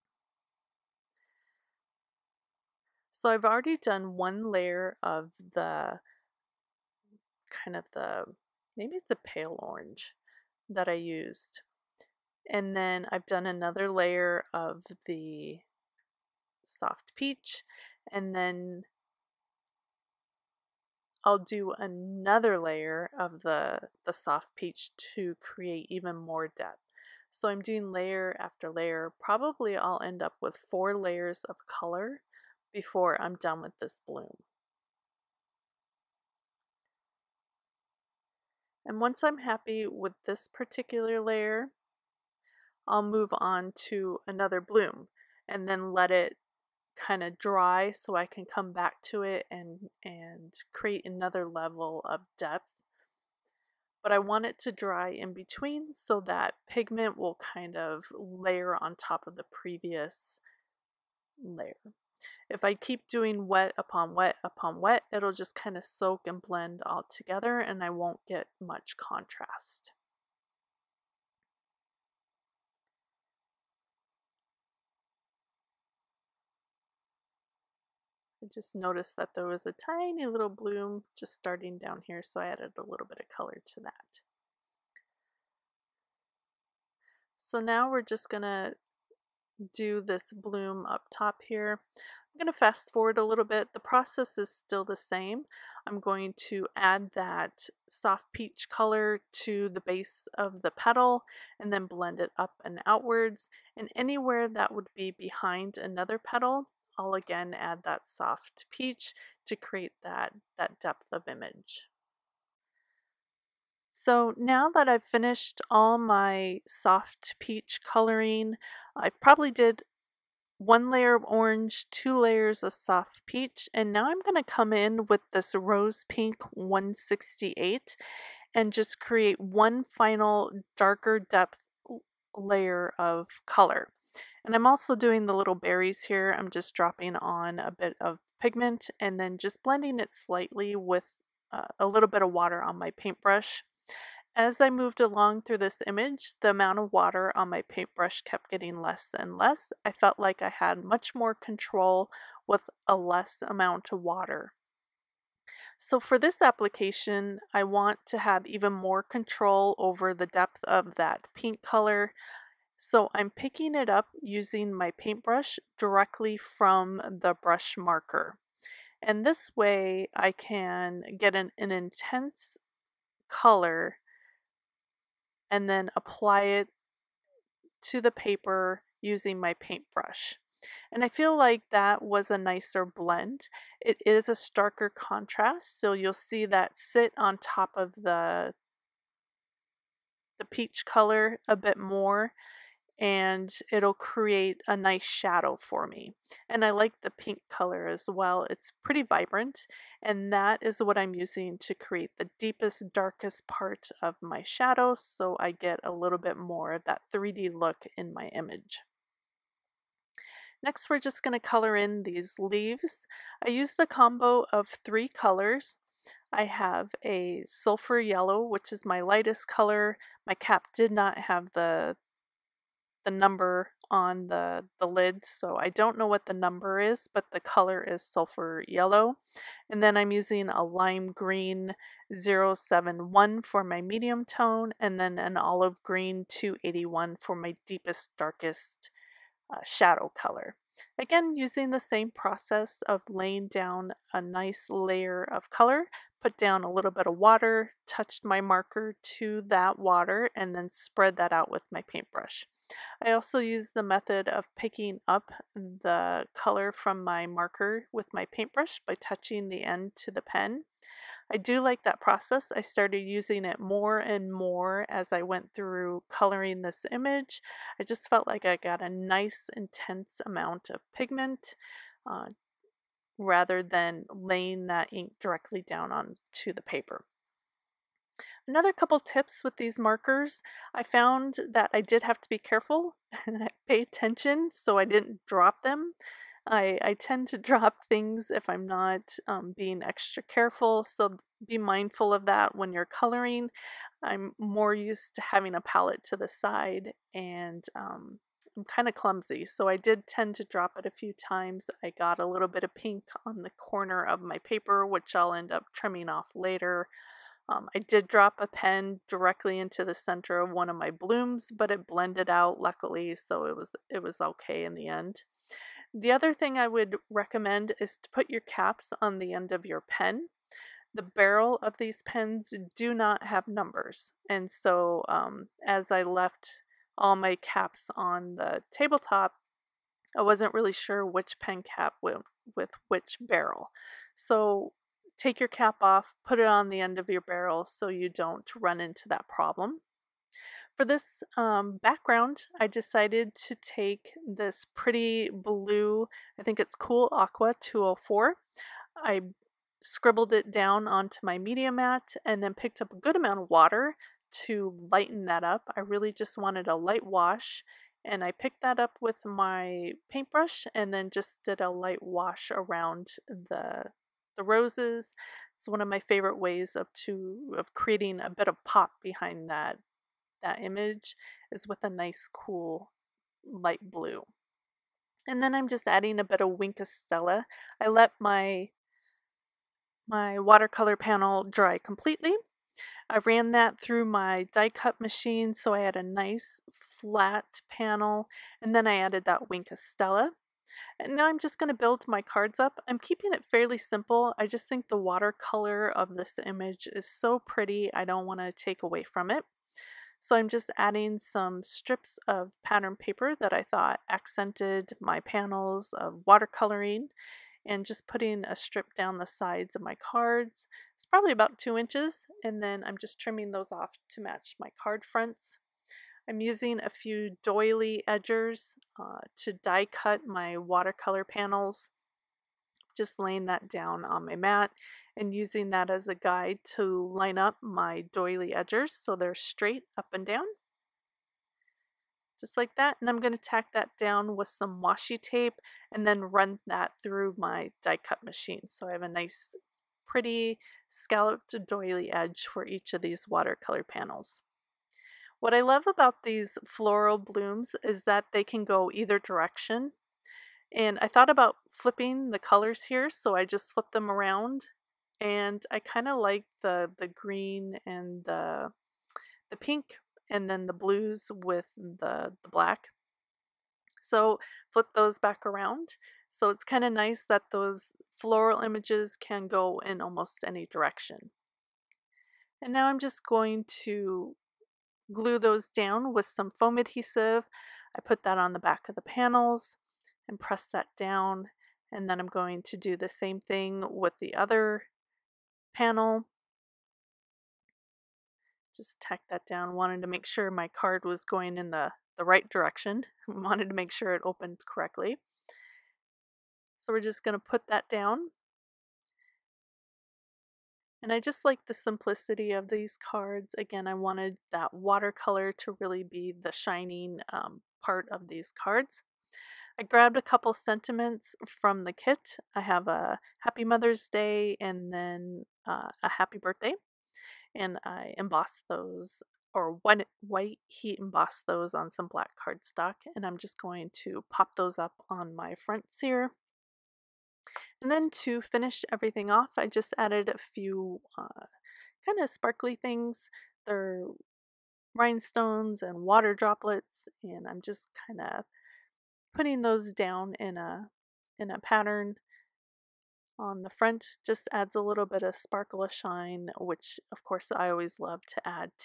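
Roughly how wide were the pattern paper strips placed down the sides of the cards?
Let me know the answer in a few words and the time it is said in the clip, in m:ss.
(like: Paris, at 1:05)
2 inches, at 6:51.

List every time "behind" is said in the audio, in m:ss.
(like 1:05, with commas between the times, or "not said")
1:45, 6:09.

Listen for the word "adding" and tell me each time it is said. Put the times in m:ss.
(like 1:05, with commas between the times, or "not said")
6:15, 6:40.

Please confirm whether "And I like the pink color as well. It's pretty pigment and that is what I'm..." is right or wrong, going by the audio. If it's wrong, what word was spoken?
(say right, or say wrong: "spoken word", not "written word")
wrong: "vibrant", not "pigment".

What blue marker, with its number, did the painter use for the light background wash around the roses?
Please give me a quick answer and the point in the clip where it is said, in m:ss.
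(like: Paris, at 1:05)
Cool Aqua 204, at 5:46.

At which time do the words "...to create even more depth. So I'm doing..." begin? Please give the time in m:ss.
0:25.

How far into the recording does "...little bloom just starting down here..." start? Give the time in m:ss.
1:20.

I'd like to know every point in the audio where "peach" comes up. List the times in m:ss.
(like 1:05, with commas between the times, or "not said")
0:17, 0:24, 1:38, 1:48, 1:57, 2:03, 3:10.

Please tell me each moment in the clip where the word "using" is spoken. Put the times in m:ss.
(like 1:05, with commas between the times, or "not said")
2:44, 2:58, 3:21, 3:50, 4:01, 4:22, 6:56, 7:05.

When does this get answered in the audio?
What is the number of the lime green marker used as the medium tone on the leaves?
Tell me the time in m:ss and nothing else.
3:50.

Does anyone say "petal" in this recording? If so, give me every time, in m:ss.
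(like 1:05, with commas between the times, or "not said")
1:40, 1:46.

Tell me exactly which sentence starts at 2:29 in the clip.
I felt like I had much more control with a less amount of water.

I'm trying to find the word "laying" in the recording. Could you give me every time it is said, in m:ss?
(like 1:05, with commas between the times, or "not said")
4:03, 4:34, 7:03.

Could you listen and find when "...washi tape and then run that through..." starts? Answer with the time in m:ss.
7:14.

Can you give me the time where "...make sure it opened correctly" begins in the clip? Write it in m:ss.
8:13.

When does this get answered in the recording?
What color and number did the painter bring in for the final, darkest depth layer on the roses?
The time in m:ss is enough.
2:05.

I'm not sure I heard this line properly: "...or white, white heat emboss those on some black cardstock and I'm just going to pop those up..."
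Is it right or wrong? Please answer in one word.
right.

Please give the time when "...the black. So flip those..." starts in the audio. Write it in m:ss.
7:42.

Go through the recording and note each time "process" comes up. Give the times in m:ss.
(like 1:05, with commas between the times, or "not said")
1:33, 4:02, 4:21.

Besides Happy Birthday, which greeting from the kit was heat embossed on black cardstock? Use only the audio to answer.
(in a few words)
Happy Mother's Day.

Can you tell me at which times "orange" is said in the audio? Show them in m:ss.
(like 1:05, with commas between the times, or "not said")
0:09, 2:01.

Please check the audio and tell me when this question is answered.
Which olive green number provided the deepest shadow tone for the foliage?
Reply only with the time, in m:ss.
3:55.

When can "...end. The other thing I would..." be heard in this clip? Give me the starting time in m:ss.
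5:14.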